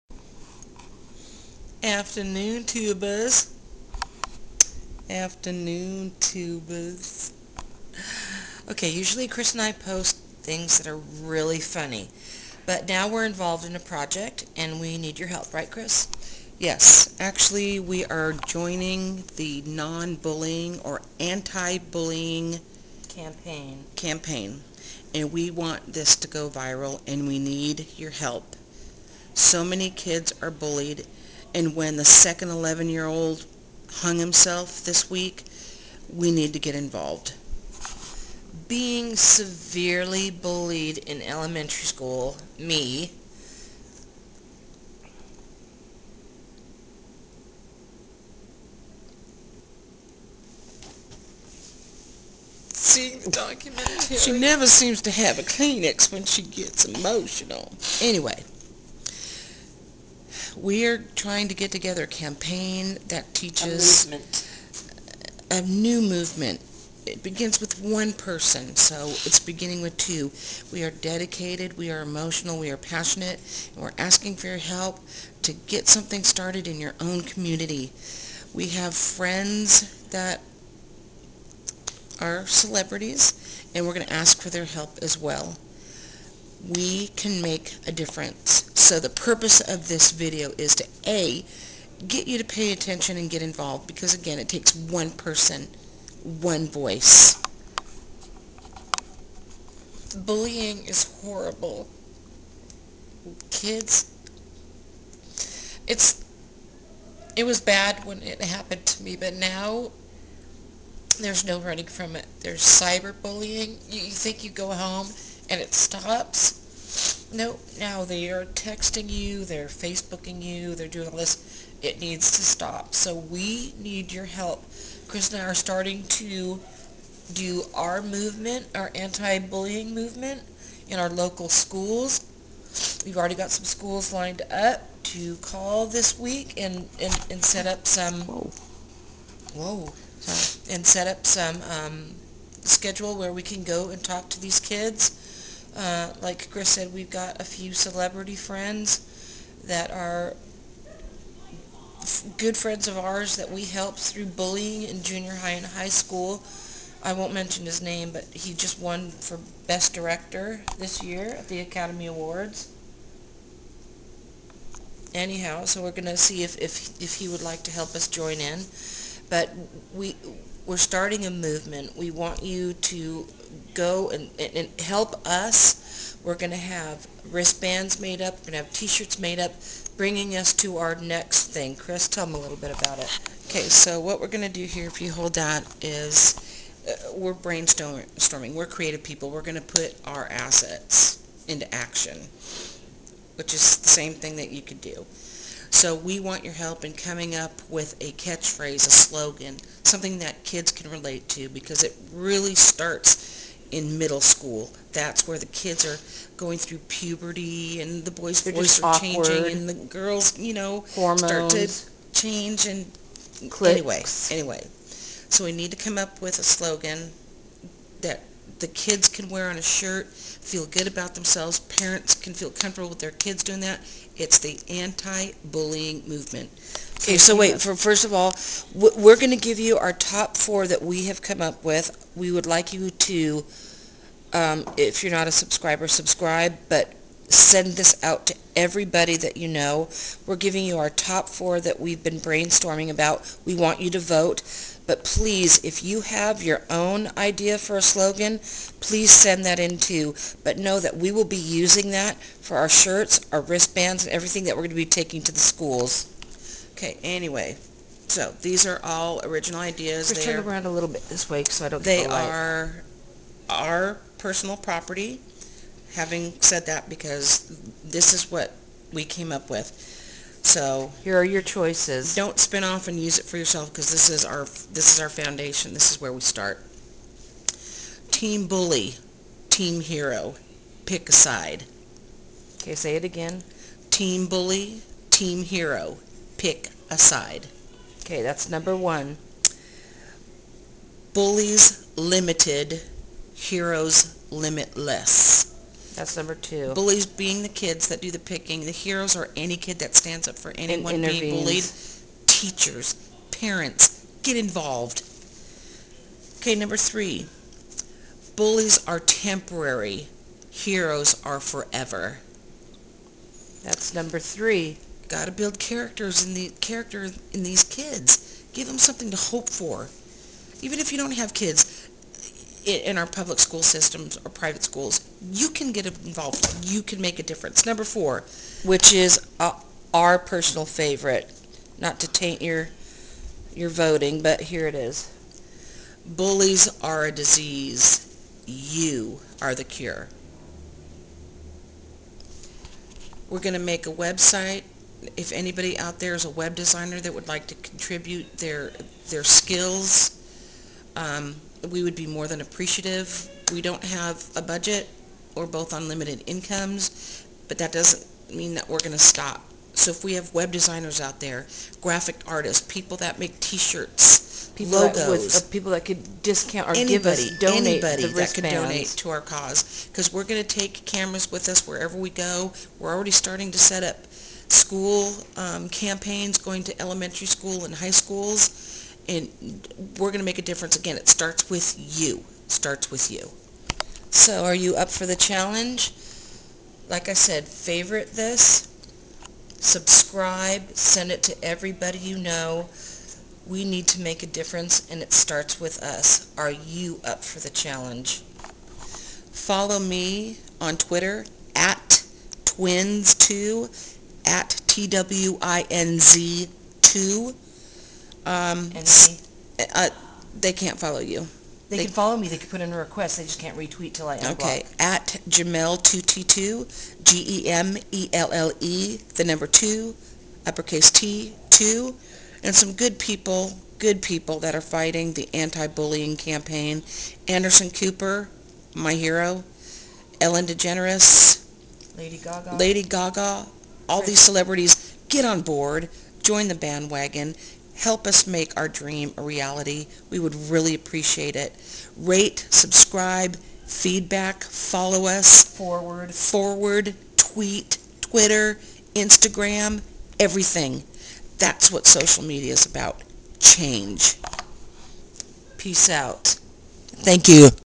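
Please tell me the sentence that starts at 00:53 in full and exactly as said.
She never seems to have a Kleenex when she gets emotional.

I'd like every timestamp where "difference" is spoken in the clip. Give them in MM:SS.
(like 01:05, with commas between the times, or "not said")
01:27, 05:27, 06:20, 06:34.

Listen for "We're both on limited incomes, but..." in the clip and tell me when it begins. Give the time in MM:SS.
05:55.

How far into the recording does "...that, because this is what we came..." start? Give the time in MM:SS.
04:26.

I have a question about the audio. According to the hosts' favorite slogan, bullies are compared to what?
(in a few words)
a disease.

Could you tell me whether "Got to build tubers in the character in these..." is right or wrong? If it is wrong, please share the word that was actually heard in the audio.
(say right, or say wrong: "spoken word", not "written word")
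wrong: "characters", not "tubers".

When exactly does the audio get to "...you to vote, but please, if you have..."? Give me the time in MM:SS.
04:03.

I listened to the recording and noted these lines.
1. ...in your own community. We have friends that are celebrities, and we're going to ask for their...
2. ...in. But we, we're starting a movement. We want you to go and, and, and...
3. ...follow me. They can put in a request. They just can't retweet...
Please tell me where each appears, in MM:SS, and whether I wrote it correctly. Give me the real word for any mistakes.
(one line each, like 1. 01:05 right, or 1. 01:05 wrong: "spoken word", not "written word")
1. 01:16 right
2. 02:48 right
3. 06:51 right.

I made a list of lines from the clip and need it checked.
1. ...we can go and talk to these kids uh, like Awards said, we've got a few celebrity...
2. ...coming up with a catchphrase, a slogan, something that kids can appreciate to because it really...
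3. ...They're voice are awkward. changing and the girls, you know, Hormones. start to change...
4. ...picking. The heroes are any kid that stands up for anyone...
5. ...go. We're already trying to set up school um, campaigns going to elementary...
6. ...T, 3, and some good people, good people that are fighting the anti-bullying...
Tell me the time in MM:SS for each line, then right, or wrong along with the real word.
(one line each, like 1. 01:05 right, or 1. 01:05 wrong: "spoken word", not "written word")
1. 02:23 wrong: "Chris", not "Awards"
2. 03:16 wrong: "relate", not "appreciate"
3. 03:28 right
4. 04:58 right
5. 06:12 wrong: "starting", not "trying"
6. 07:00 wrong: "2", not "3".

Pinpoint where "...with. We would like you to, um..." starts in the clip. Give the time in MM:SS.
03:51.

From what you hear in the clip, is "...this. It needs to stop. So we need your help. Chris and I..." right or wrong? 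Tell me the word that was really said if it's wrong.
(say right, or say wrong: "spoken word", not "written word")
right.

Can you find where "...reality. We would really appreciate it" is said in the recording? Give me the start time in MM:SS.
07:19.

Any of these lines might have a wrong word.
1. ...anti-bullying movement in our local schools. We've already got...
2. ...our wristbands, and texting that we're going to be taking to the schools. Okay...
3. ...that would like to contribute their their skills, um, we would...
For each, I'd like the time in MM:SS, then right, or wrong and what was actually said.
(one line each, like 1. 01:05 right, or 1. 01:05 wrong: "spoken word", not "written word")
1. 02:08 right
2. 04:13 wrong: "everything", not "texting"
3. 05:46 right.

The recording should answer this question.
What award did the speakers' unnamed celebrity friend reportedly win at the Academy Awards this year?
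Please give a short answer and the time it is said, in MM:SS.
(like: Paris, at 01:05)
Best Director, at 02:39.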